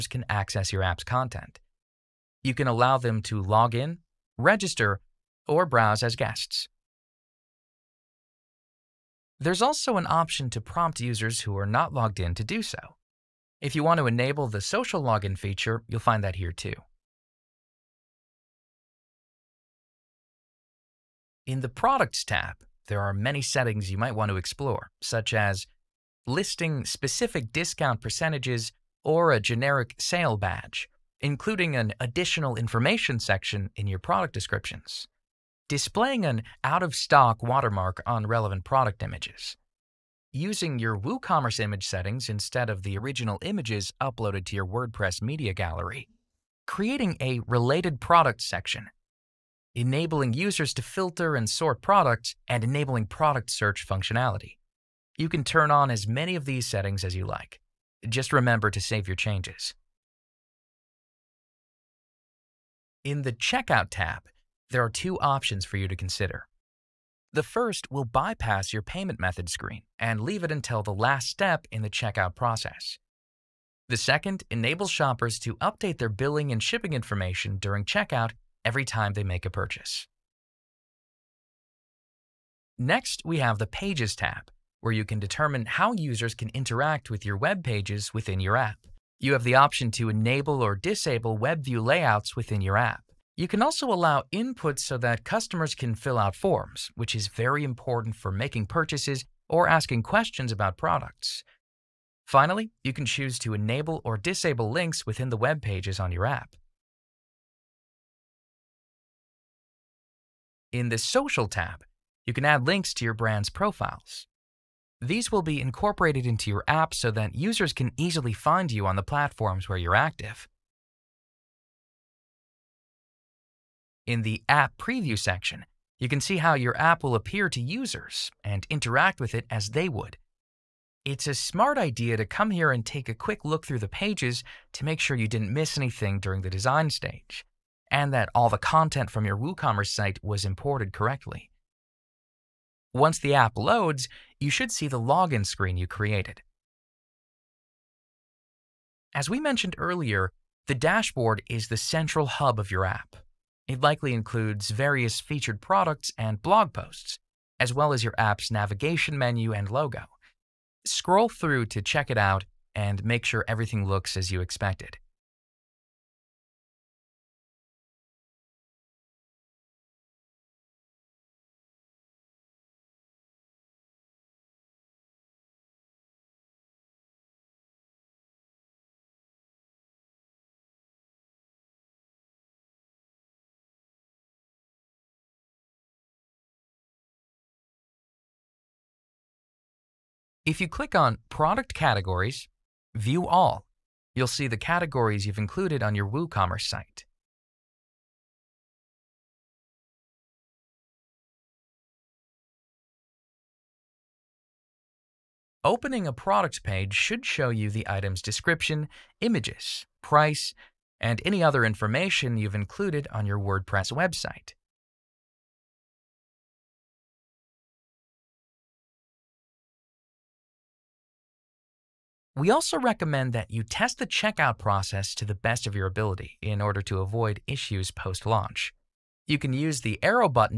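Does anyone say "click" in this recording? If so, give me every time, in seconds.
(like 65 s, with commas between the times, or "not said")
190 s.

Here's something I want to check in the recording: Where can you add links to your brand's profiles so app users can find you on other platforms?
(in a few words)
Social tab.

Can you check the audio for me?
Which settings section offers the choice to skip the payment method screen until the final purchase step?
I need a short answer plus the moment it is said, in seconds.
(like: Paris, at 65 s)
Checkout tab, at 63 s.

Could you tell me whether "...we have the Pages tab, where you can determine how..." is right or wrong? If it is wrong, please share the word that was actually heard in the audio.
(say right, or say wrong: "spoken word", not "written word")
right.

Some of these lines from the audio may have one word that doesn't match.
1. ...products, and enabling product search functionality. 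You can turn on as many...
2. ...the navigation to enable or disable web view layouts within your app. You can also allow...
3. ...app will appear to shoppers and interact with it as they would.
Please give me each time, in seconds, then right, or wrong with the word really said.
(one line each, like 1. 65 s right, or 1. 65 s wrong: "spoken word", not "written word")
1. 51 s right
2. 89 s wrong: "option", not "navigation"
3. 126 s wrong: "users", not "shoppers".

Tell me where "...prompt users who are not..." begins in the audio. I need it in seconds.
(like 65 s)
10 s.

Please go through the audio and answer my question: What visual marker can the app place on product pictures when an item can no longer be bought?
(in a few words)
out-of-stock watermark.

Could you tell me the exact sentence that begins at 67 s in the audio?
The first will bypass your payment method screen and leave it until the last step in the checkout process.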